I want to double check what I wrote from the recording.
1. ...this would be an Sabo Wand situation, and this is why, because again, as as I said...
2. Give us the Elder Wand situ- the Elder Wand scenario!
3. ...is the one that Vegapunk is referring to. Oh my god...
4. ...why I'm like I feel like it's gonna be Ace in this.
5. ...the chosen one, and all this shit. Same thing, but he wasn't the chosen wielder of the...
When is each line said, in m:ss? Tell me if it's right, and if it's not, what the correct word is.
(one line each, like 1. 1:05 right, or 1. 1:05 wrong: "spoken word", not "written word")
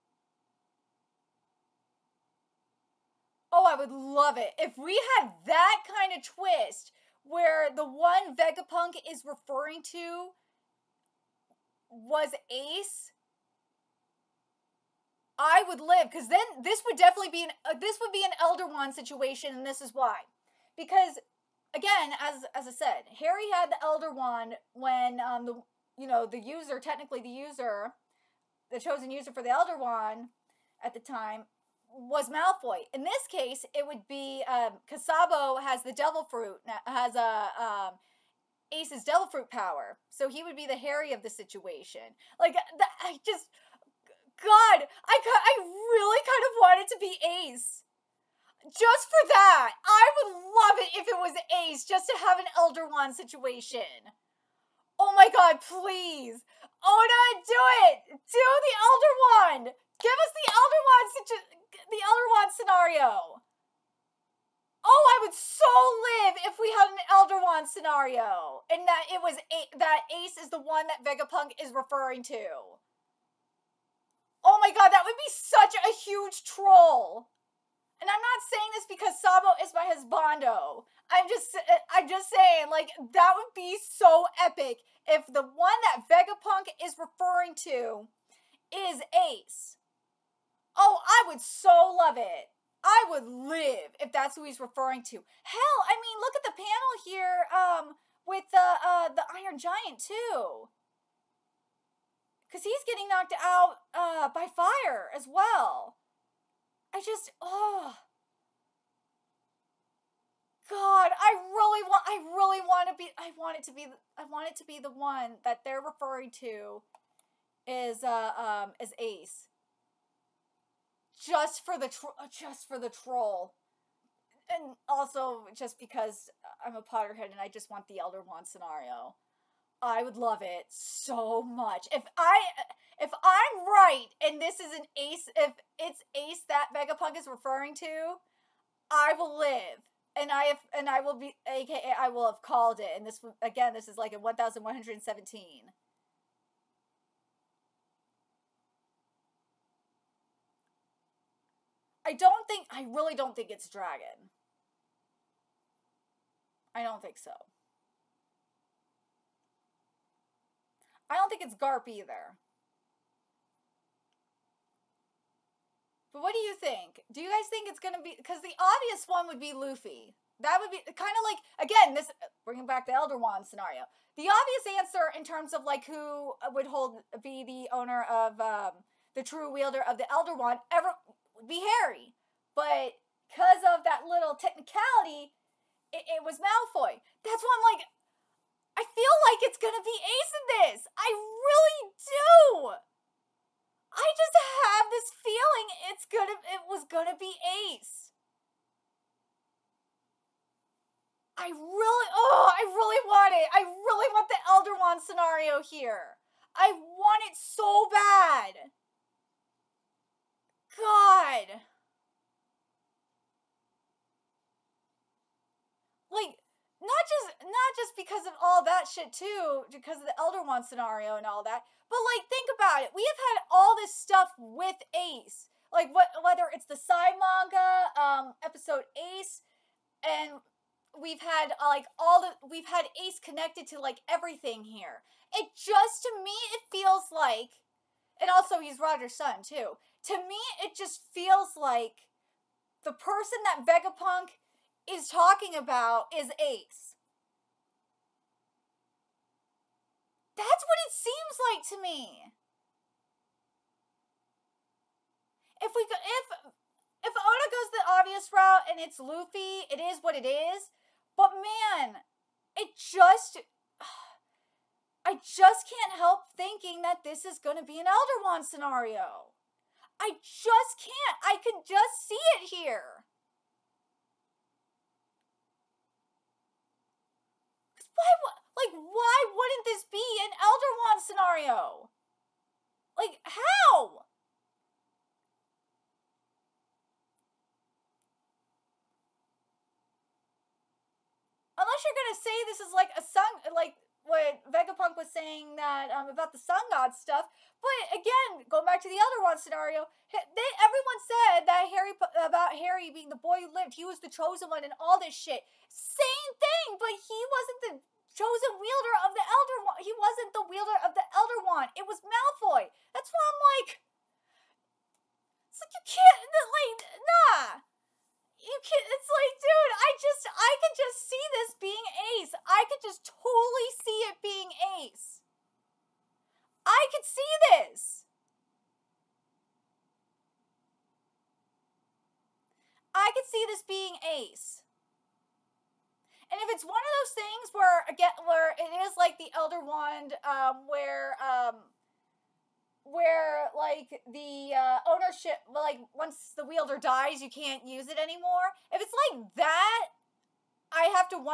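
1. 0:17 wrong: "Elder", not "Sabo"
2. 1:00 right
3. 1:10 right
4. 3:07 right
5. 5:03 right.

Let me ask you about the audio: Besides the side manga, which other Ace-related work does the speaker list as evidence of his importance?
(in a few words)
Episode Ace.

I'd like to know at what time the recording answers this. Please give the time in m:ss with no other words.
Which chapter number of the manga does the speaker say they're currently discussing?
2:24.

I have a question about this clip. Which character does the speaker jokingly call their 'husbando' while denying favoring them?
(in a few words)
Sabo.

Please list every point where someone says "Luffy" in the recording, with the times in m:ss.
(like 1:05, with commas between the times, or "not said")
2:49, 4:18.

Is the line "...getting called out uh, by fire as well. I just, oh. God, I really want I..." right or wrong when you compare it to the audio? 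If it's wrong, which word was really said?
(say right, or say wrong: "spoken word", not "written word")
wrong: "knocked", not "called".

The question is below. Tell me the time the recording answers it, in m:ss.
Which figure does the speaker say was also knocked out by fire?
1:39.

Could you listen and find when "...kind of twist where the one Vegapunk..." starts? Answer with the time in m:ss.
0:05.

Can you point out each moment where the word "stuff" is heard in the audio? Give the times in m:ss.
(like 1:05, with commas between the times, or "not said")
3:43, 4:56.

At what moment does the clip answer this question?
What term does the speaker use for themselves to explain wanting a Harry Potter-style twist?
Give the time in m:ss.
2:06.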